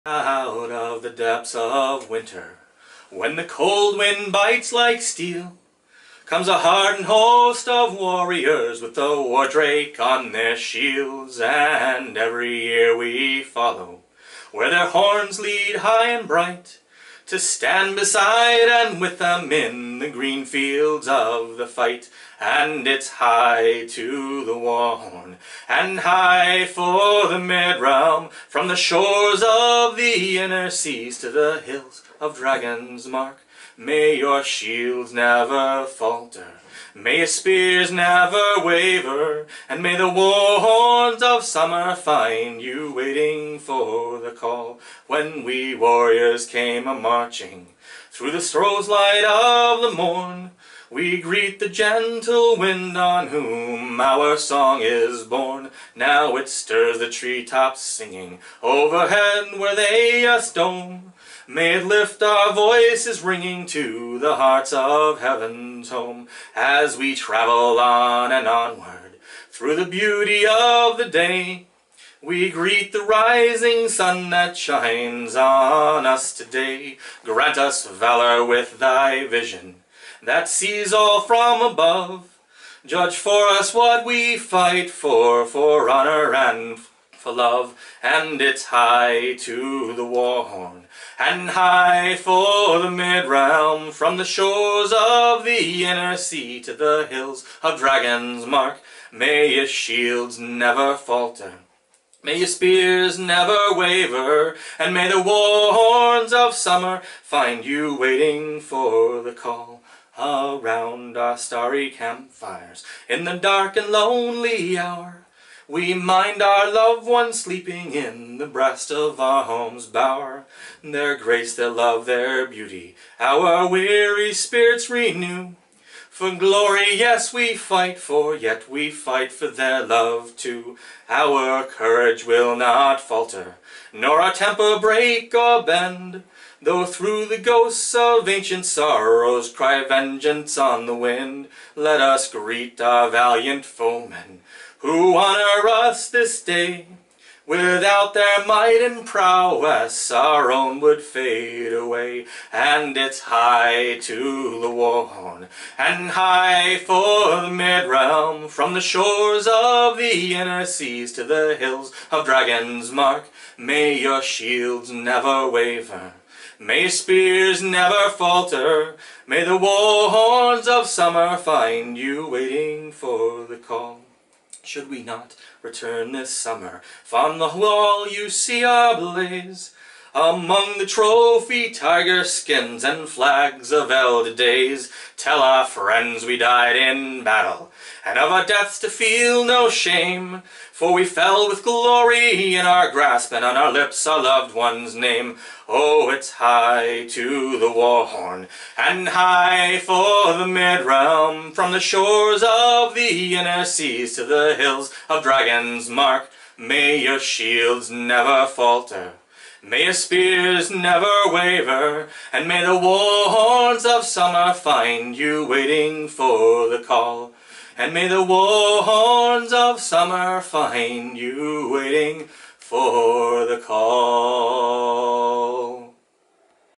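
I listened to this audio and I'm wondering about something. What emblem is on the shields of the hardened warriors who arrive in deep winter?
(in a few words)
war drake.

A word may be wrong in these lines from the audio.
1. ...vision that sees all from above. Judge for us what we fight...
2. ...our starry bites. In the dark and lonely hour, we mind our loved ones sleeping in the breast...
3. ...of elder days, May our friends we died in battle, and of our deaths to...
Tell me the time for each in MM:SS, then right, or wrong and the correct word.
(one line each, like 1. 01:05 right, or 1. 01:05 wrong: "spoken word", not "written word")
1. 01:19 right
2. 01:51 wrong: "campfires", not "bites"
3. 03:03 wrong: "Tell", not "May".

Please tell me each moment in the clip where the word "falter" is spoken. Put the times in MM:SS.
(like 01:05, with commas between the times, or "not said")
00:35, 01:40, 02:12, 02:48, 03:28.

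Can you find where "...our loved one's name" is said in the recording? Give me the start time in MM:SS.
03:14.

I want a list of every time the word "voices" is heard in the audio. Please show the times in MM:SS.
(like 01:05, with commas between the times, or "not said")
01:02.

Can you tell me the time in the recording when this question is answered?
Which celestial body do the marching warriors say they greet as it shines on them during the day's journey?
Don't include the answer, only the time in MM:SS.
01:13.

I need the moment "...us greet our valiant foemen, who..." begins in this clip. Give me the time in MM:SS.
02:22.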